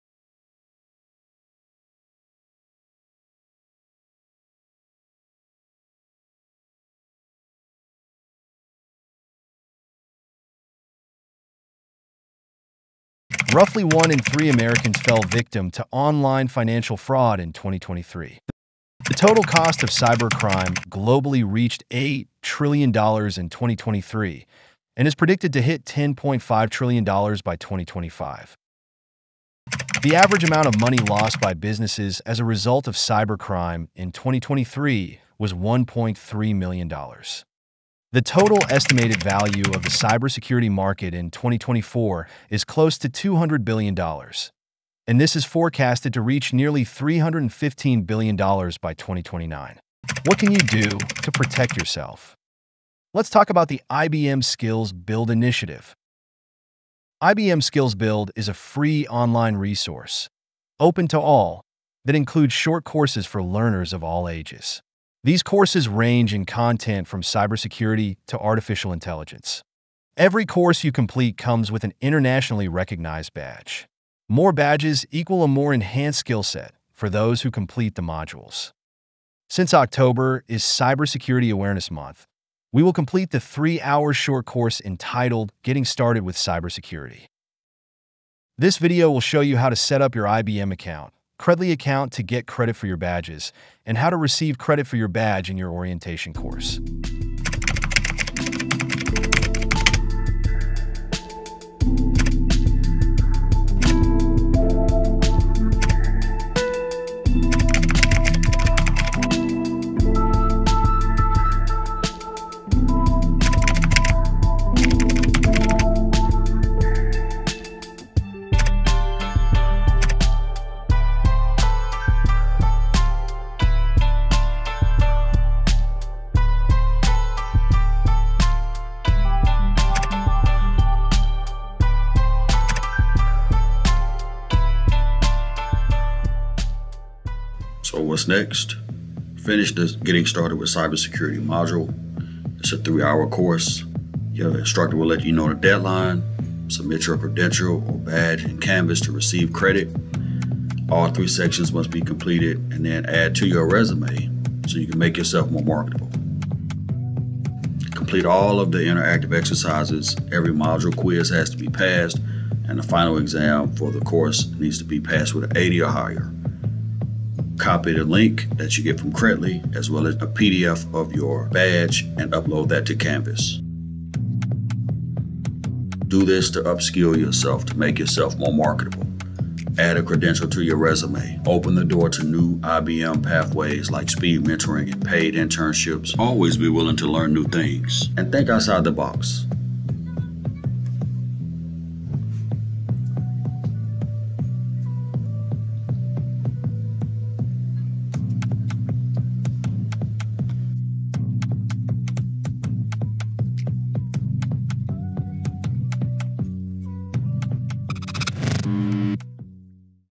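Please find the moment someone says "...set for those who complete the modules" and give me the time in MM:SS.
01:16.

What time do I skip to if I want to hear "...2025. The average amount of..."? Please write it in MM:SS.
00:27.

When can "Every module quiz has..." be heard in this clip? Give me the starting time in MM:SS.
02:40.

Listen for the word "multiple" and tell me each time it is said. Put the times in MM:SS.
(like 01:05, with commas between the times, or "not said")
not said.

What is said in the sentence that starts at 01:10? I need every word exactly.
Every course you complete comes with an internationally recognized badge.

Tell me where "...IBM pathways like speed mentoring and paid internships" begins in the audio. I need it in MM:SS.
03:02.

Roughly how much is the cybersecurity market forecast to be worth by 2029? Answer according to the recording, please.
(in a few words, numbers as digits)
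$315 billion.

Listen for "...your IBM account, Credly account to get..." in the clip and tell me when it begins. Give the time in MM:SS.
01:30.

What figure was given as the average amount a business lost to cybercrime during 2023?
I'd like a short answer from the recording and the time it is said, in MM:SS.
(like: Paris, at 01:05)
$1.3 million, at 00:35.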